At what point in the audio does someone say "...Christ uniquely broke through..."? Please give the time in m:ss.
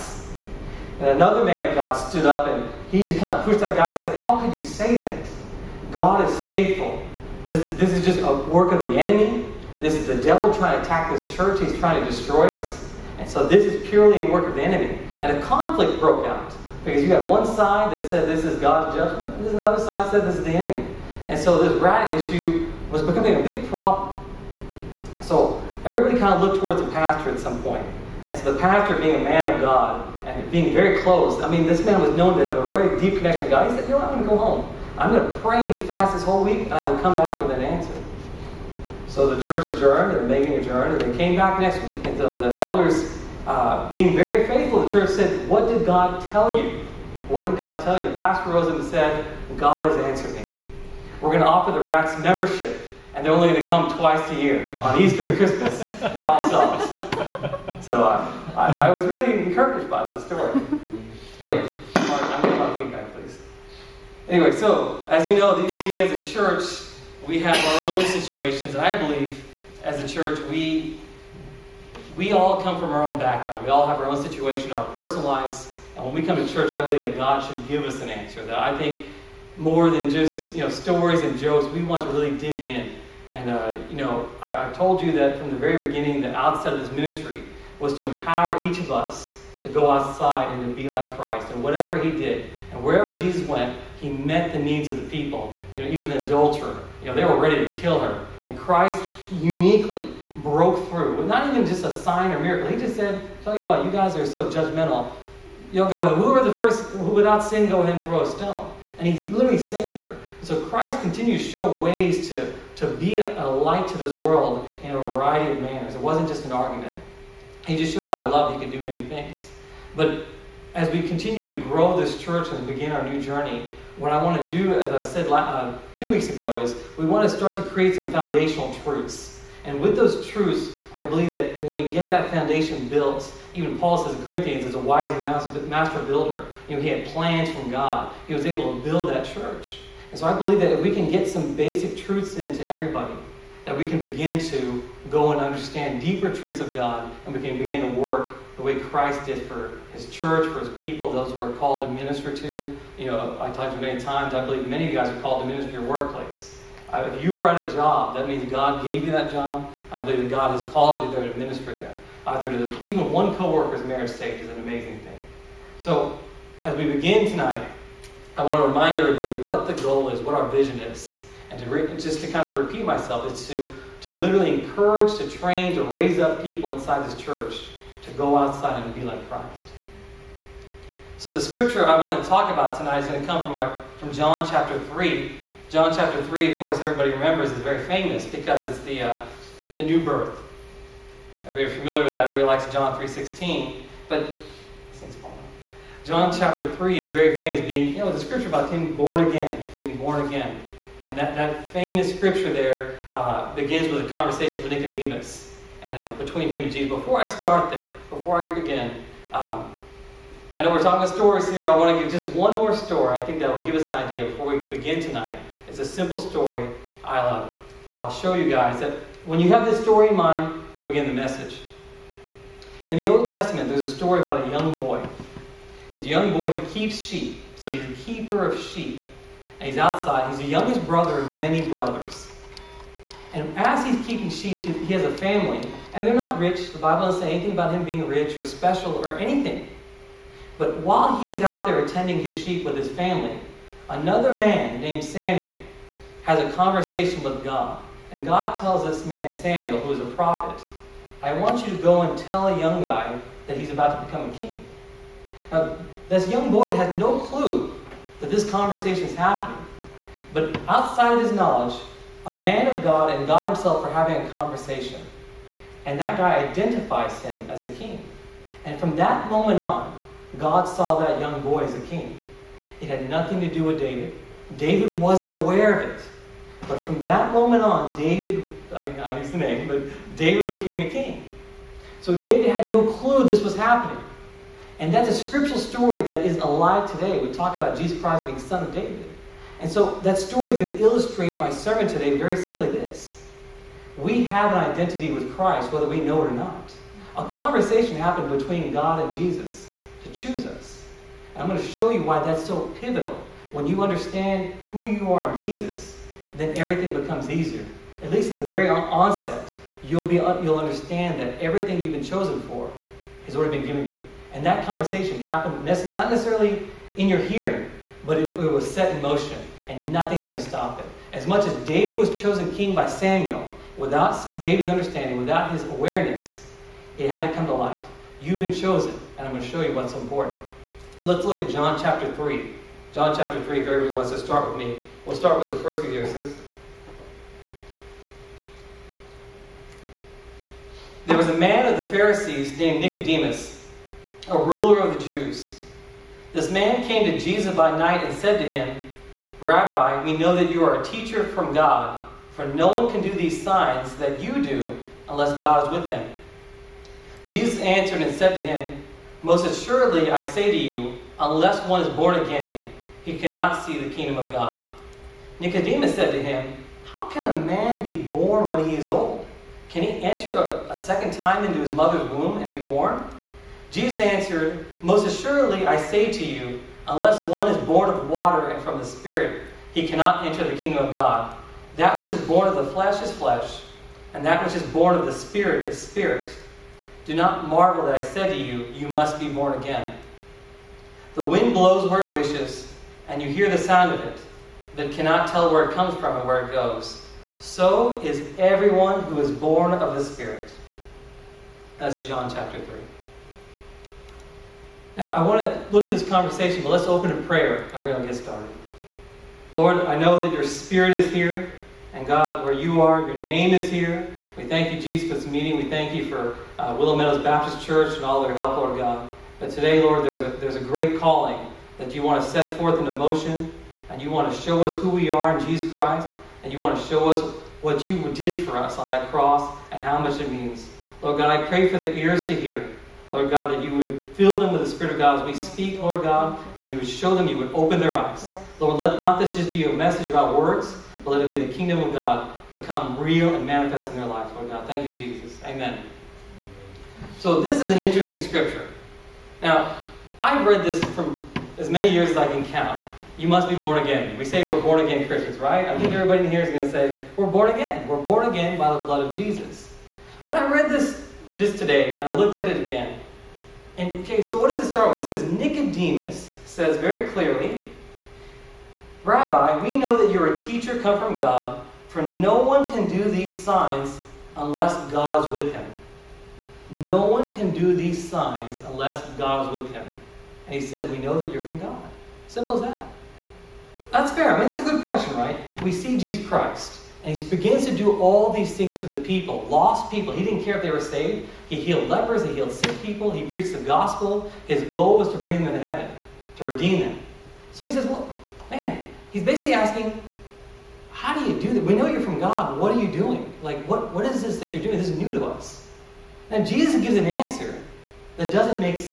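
1:38.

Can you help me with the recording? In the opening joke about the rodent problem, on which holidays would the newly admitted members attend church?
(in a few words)
Easter.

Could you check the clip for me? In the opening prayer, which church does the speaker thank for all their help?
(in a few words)
Willow Meadows Baptist Church.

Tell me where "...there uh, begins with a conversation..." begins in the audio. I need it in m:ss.
3:22.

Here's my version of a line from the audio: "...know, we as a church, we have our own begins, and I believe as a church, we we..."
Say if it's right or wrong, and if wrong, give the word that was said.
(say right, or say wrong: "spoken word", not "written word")
wrong: "situations", not "begins".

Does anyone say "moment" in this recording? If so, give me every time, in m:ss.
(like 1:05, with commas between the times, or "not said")
4:29, 4:37.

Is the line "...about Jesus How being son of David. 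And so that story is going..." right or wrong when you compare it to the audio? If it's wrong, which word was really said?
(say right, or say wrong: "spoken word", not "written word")
wrong: "Christ", not "How".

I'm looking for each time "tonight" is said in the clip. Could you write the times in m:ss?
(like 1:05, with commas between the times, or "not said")
2:47, 3:02, 3:35.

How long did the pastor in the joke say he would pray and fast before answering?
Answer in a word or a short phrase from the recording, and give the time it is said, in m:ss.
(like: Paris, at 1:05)
this whole week, at 0:36.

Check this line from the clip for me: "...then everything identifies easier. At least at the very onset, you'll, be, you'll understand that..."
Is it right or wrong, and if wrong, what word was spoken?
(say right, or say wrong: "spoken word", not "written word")
wrong: "becomes", not "identifies".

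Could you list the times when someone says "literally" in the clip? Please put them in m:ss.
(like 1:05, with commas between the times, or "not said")
1:49, 2:54.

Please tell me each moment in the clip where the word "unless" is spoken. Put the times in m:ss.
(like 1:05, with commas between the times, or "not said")
5:55, 6:01, 6:16, 7:54, 7:58.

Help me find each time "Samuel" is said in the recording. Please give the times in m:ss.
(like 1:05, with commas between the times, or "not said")
4:05, 4:09, 5:22.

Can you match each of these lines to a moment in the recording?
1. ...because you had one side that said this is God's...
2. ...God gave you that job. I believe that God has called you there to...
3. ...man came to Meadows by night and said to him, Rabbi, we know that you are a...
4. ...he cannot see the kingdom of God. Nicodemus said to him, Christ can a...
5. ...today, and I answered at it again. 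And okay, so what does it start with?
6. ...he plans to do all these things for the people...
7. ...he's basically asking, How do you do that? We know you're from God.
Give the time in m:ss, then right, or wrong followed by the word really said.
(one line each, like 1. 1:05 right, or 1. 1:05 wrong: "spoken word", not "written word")
1. 0:16 right
2. 2:38 right
3. 5:46 wrong: "Jesus", not "Meadows"
4. 6:03 wrong: "How", not "Christ"
5. 7:41 wrong: "looked", not "answered"
6. 8:07 wrong: "begins", not "plans"
7. 8:19 right.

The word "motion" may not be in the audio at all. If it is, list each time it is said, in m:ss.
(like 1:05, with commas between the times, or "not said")
5:19, 7:02.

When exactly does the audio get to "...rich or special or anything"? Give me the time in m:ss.
3:58.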